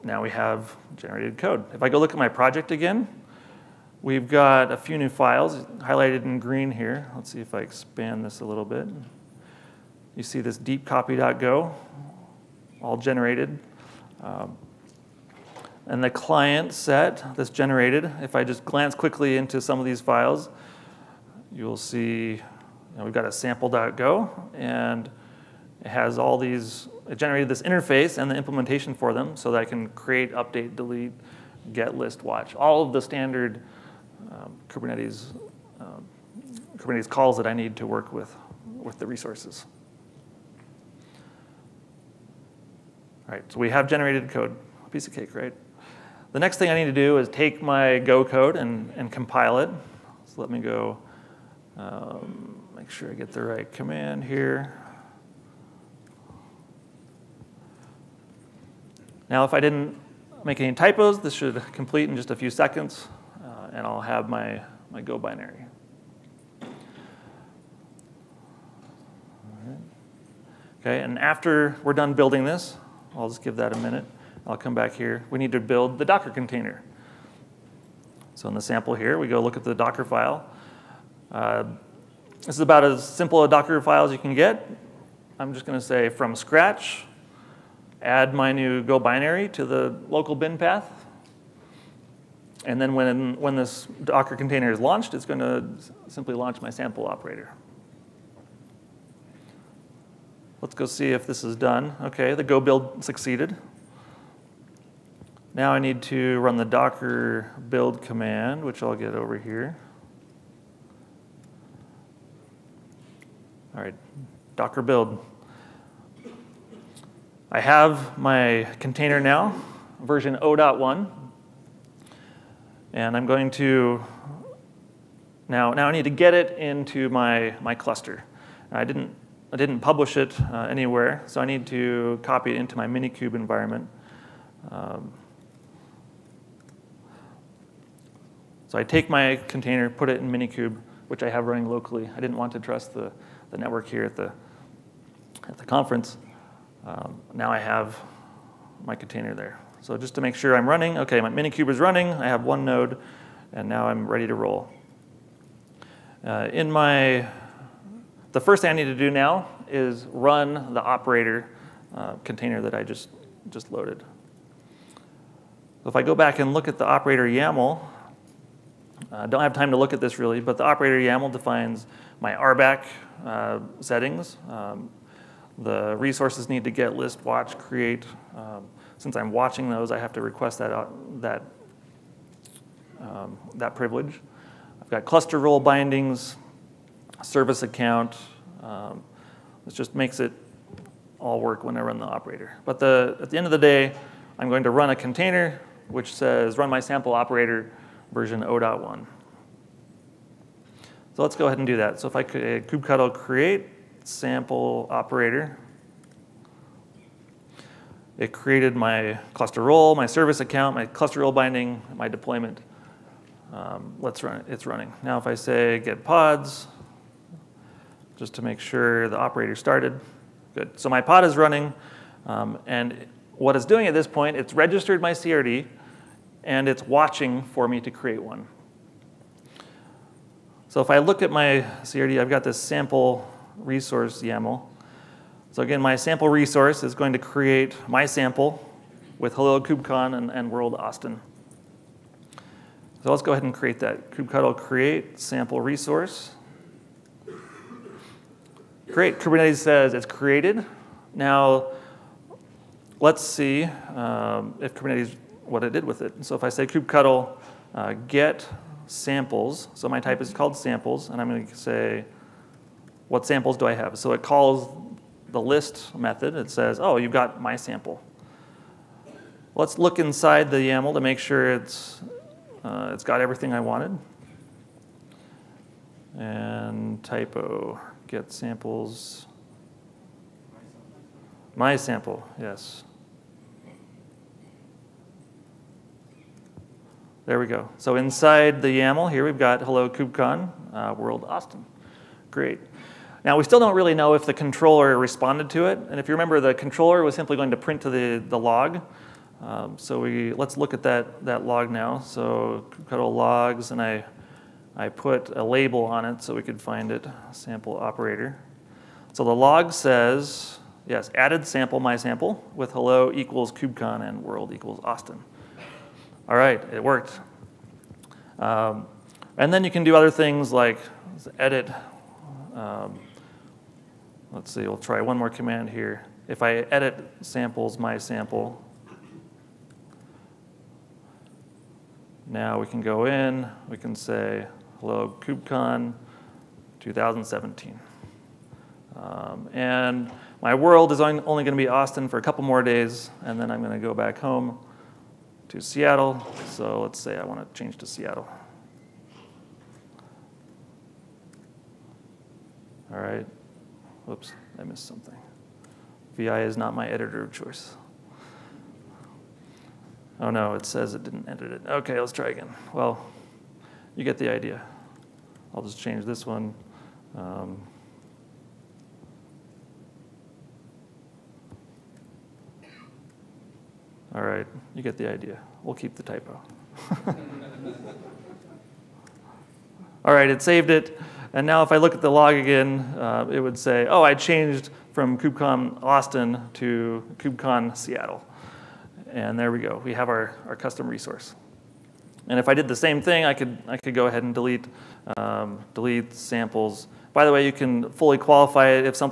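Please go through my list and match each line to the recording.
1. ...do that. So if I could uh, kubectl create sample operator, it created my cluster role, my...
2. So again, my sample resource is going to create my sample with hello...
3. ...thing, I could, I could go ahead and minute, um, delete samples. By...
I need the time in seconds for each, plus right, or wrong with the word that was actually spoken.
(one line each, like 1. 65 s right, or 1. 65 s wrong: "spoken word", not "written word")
1. 201 s right
2. 235 s right
3. 392 s wrong: "delete", not "minute".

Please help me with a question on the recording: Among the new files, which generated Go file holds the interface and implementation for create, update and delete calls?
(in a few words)
sample.go.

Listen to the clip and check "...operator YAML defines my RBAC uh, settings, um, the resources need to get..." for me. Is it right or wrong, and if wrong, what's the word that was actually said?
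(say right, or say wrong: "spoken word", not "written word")
right.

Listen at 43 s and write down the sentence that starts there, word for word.
All right, so we have generated code, a piece of cake, right?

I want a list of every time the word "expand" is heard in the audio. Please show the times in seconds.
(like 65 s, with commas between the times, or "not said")
7 s.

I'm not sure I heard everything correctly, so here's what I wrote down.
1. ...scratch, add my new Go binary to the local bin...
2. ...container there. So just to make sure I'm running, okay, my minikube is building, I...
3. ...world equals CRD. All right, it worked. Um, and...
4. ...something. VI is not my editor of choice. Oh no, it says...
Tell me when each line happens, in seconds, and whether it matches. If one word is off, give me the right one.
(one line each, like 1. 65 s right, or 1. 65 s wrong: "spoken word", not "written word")
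1. 86 s right
2. 148 s wrong: "running", not "building"
3. 314 s wrong: "Austin", not "CRD"
4. 354 s right.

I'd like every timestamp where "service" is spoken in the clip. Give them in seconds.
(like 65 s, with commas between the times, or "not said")
187 s, 210 s.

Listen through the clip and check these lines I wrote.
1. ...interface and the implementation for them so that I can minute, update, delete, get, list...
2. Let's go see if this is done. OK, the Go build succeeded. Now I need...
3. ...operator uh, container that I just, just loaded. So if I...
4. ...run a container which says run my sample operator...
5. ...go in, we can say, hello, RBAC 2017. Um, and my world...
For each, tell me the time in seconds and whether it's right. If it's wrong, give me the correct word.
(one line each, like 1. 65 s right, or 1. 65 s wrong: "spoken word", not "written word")
1. 27 s wrong: "create", not "minute"
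2. 100 s right
3. 160 s right
4. 194 s right
5. 332 s wrong: "KubeCon", not "RBAC".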